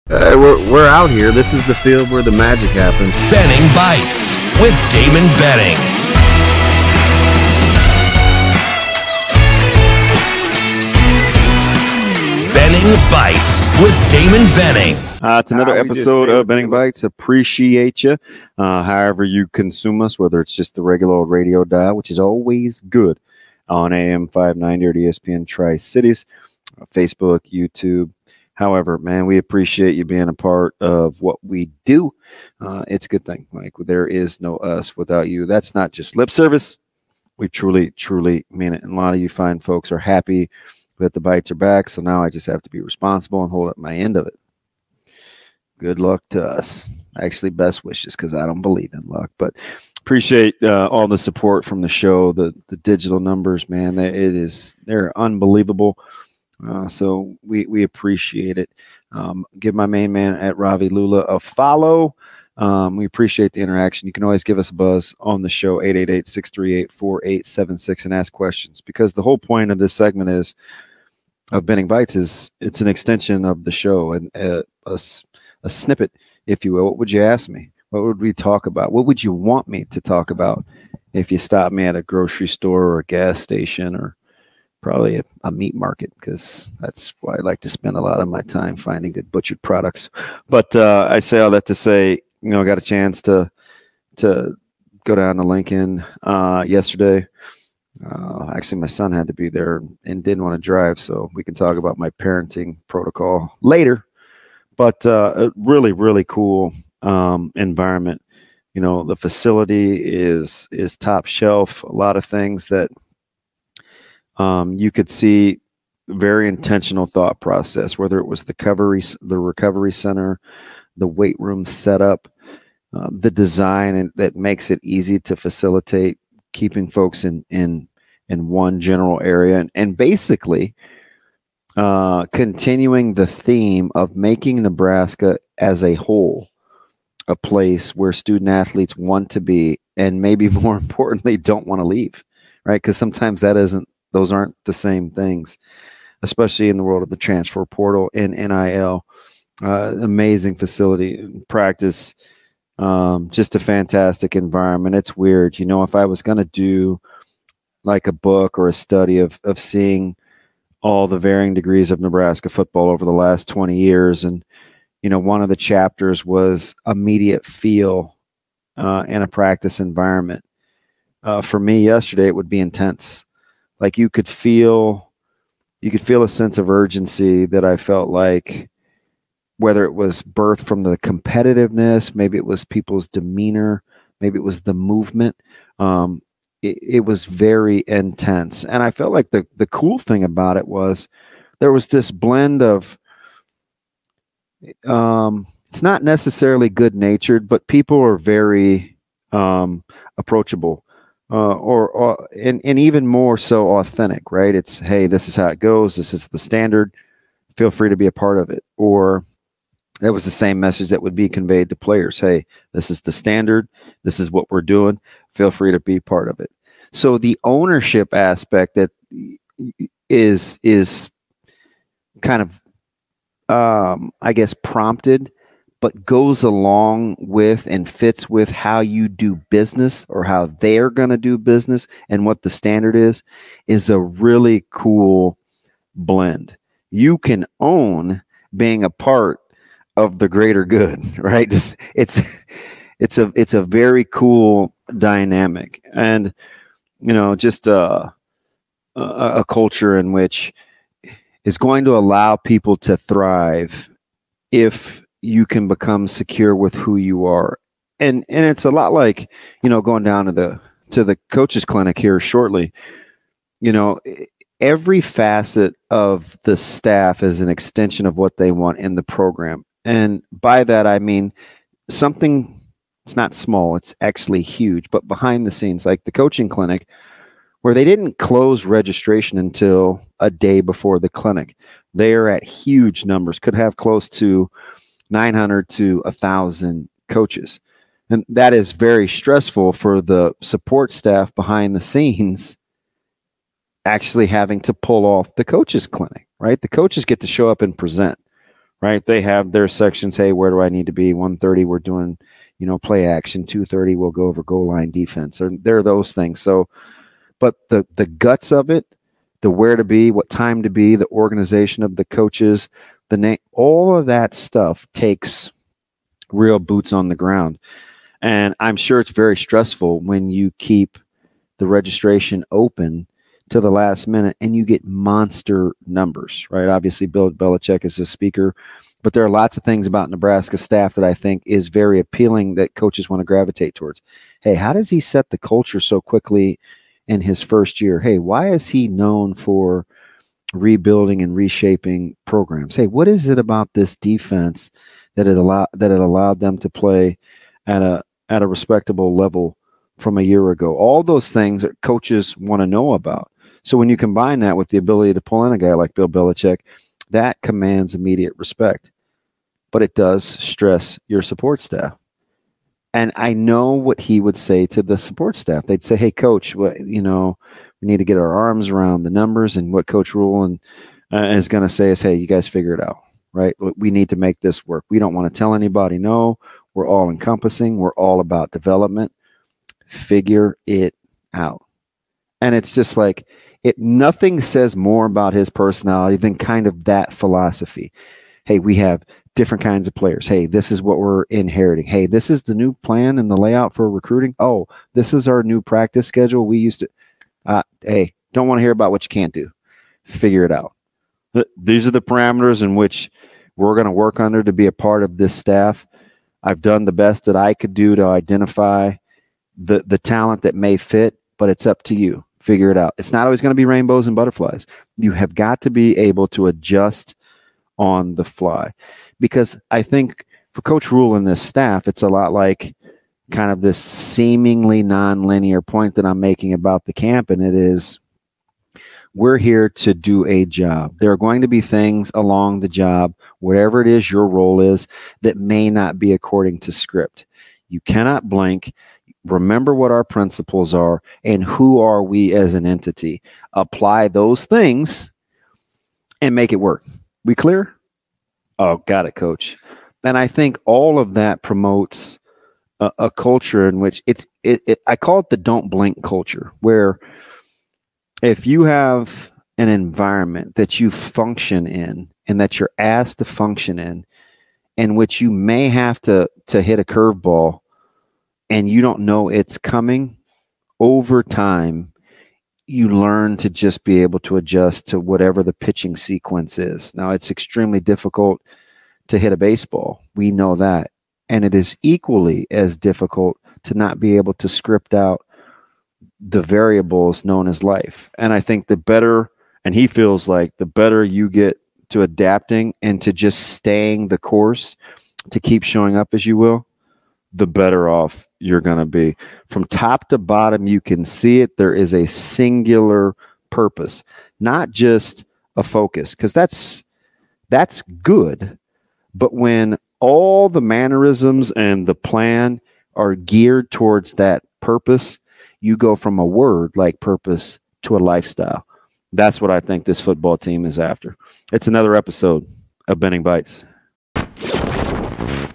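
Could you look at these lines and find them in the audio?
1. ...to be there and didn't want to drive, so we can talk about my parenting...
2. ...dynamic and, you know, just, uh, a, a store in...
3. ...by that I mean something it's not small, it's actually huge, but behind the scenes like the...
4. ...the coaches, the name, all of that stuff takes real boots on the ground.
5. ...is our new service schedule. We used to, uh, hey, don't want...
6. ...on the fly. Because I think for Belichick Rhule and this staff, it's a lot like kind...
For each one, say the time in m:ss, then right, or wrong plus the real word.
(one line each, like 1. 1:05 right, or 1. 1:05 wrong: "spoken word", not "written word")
1. 1:39 right
2. 4:04 wrong: "culture", not "store"
3. 4:30 right
4. 5:11 right
5. 6:35 wrong: "practice", not "service"
6. 6:57 wrong: "Coach", not "Belichick".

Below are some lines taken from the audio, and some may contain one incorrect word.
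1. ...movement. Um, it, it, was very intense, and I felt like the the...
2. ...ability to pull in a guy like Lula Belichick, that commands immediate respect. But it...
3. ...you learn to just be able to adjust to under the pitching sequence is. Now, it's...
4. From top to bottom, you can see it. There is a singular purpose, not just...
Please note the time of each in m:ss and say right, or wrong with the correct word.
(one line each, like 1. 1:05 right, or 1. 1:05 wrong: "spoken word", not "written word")
1. 3:04 right
2. 5:54 wrong: "Bill", not "Lula"
3. 7:52 wrong: "whatever", not "under"
4. 8:19 right.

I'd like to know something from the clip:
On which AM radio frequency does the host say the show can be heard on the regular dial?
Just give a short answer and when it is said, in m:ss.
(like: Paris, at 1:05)
590, at 0:23.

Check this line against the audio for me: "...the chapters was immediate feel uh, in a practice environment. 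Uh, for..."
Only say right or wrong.
right.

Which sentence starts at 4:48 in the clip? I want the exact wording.
And that is very stressful for the support staff behind the scenes actually having to pull off the coaches clinic, right?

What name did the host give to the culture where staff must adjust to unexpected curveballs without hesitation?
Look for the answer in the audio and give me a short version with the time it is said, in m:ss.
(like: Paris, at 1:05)
Don't blink culture, at 7:35.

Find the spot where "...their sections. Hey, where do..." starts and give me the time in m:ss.
4:59.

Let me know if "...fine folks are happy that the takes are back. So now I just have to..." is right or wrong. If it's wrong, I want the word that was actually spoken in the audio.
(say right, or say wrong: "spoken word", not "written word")
wrong: "bites", not "takes".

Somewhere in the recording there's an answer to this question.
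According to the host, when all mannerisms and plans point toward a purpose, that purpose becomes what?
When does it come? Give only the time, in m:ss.
8:37.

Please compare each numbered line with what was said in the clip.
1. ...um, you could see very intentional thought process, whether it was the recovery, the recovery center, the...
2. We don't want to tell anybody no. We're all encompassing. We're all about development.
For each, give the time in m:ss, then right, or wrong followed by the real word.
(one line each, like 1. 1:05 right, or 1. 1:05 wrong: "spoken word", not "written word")
1. 1:54 right
2. 6:14 right.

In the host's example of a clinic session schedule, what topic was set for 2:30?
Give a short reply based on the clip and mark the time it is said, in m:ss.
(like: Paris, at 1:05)
Goal line defense, at 5:04.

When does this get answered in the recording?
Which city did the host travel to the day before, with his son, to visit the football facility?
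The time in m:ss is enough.
1:35.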